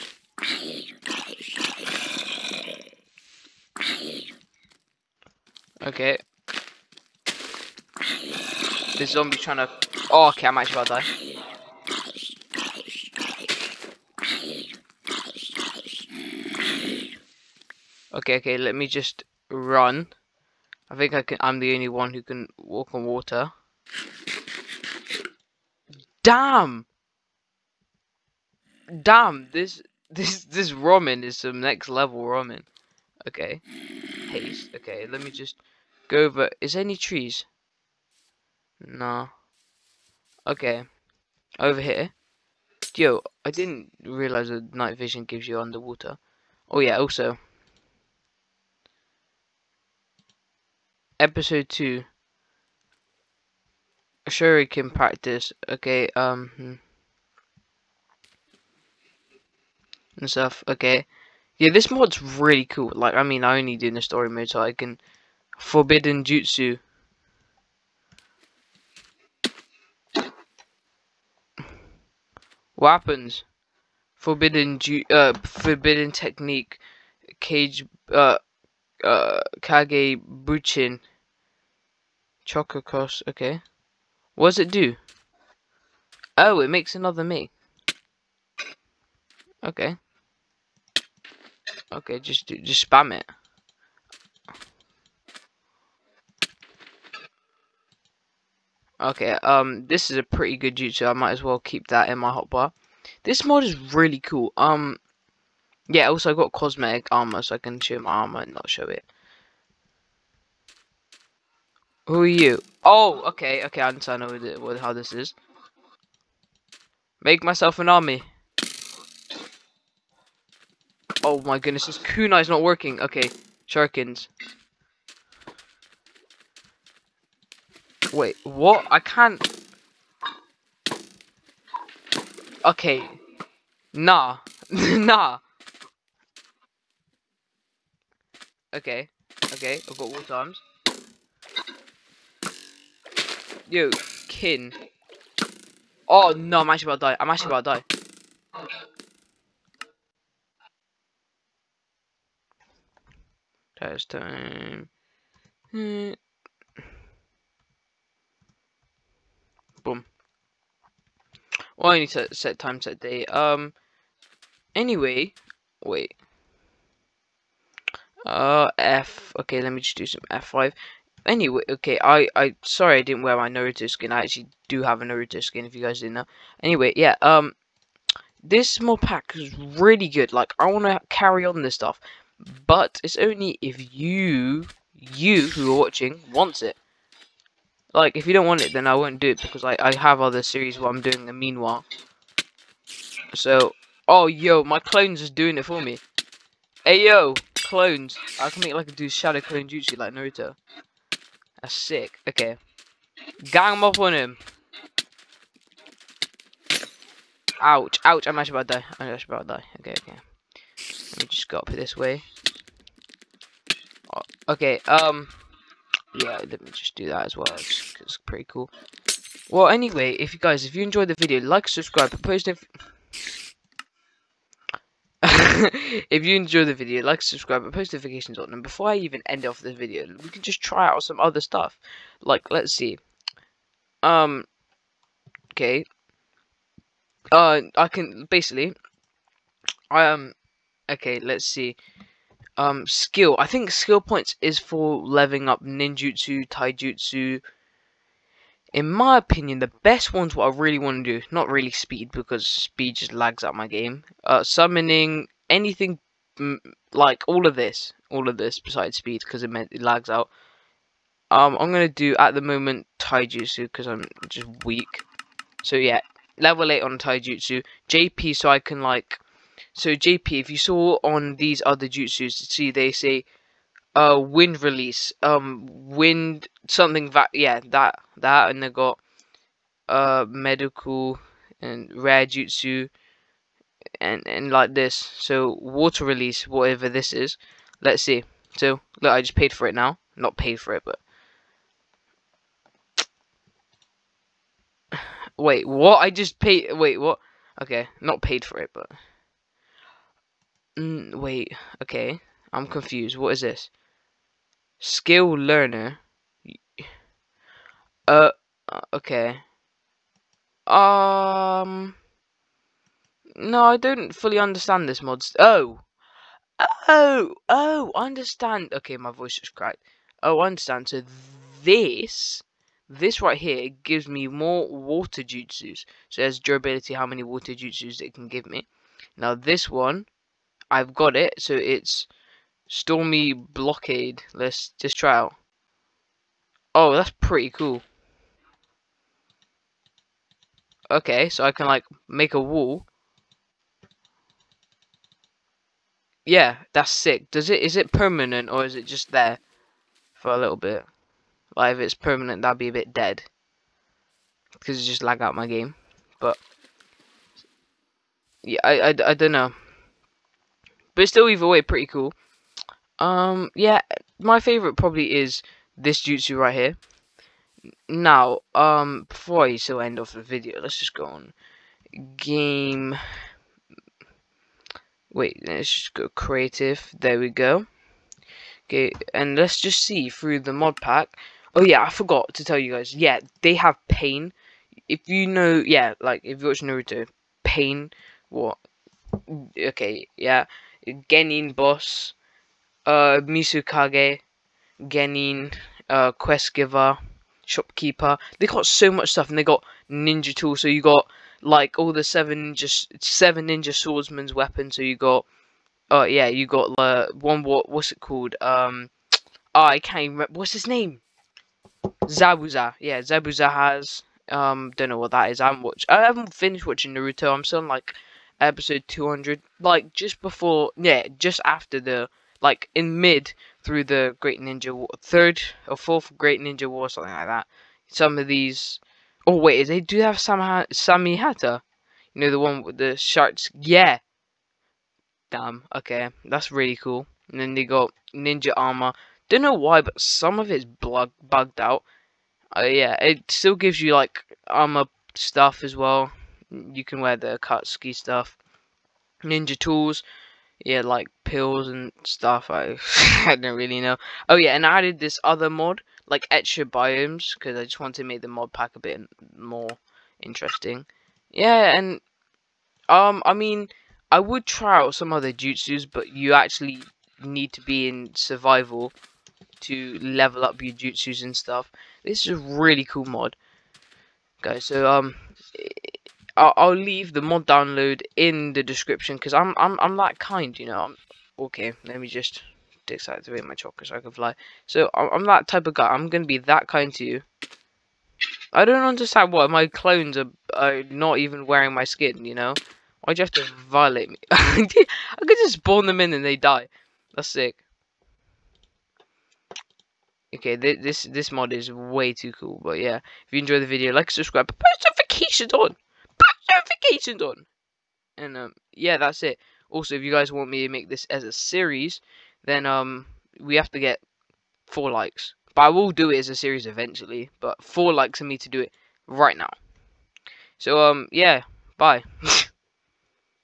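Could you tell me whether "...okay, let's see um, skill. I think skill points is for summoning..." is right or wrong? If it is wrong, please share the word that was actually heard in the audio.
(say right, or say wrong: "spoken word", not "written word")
wrong: "leveling", not "summoning".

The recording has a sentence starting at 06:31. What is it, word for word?
Genin boss, uh, Mizukage, Genin, uh, quest giver, shopkeeper.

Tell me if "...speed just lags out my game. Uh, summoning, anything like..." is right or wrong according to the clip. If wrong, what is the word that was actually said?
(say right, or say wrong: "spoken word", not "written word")
right.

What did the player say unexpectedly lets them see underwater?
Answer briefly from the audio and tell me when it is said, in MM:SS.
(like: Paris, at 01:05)
Night vision, at 00:44.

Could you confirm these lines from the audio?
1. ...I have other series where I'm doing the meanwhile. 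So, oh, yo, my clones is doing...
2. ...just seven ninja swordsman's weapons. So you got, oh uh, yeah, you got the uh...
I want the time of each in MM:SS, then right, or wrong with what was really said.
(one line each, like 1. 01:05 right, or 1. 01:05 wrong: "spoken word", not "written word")
1. 03:09 right
2. 06:42 right.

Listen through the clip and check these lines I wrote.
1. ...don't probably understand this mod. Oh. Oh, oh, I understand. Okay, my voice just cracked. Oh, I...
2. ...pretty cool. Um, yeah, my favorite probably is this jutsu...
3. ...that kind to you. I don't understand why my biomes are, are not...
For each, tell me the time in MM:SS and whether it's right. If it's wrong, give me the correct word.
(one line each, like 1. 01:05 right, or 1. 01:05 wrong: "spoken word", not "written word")
1. 05:13 wrong: "fully", not "probably"
2. 06:01 right
3. 08:06 wrong: "clones", not "biomes".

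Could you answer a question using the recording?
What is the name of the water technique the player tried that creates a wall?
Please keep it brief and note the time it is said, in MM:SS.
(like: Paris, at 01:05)
Stormy Blockade, at 05:32.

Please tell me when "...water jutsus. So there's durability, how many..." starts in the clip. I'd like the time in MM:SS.
05:24.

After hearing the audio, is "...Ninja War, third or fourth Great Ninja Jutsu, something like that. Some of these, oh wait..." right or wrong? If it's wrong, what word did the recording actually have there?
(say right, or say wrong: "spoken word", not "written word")
wrong: "War", not "Jutsu".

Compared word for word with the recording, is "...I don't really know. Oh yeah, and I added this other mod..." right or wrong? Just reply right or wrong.
right.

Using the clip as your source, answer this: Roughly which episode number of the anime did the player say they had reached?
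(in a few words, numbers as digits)
200.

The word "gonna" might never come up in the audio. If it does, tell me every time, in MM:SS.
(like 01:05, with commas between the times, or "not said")
04:21, 08:06.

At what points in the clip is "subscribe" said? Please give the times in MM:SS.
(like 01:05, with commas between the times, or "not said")
03:41, 03:47, 08:24.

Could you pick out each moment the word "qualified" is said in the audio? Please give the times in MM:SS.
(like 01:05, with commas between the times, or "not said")
not said.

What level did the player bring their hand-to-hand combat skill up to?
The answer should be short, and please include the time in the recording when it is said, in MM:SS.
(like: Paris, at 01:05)
8, at 04:26.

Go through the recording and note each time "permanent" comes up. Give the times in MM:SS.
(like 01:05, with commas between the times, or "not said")
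05:47, 05:51.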